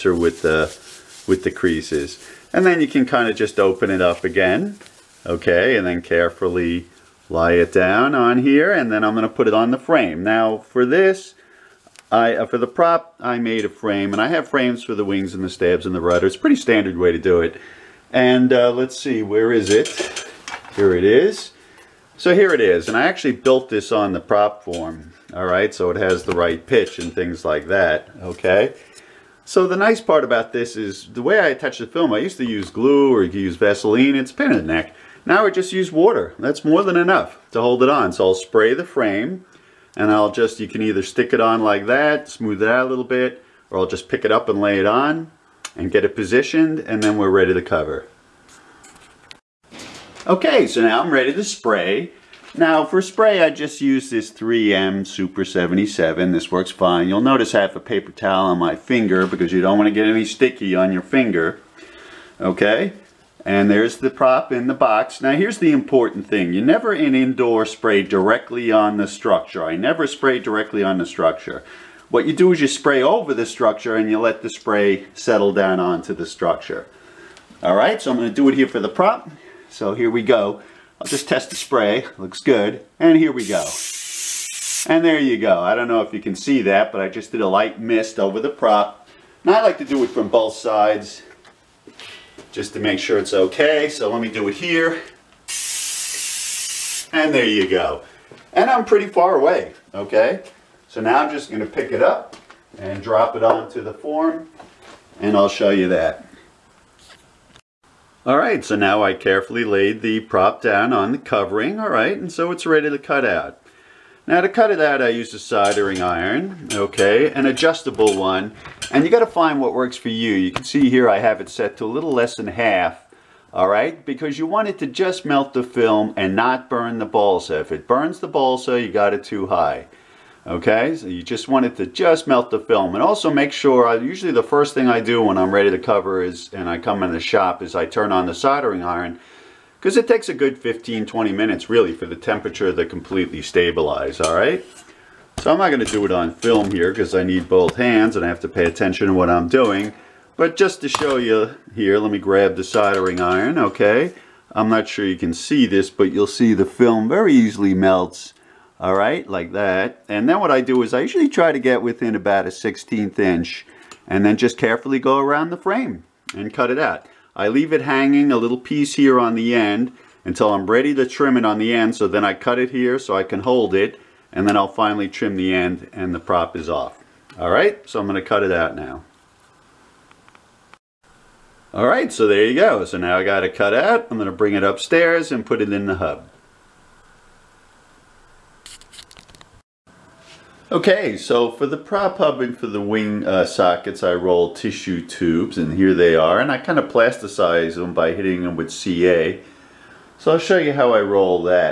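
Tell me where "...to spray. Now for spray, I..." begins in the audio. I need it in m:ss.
0:51.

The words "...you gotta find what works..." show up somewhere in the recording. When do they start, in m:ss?
1:59.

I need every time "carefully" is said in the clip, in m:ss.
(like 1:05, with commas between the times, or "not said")
0:06, 1:49, 2:44.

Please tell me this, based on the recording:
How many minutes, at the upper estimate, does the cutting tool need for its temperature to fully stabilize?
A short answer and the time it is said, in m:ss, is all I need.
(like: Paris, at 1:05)
20, at 2:21.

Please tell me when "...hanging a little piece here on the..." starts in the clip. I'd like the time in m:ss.
2:47.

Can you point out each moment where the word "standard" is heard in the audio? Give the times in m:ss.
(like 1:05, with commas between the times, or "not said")
0:16.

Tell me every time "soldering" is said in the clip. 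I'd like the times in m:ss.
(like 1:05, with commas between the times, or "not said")
1:55, 2:18, 2:32.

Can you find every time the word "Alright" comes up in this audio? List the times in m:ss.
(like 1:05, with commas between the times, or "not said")
2:57, 3:01.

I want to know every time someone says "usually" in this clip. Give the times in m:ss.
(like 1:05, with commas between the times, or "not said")
2:13, 2:41.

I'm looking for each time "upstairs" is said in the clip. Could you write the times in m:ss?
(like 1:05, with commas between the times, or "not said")
3:04.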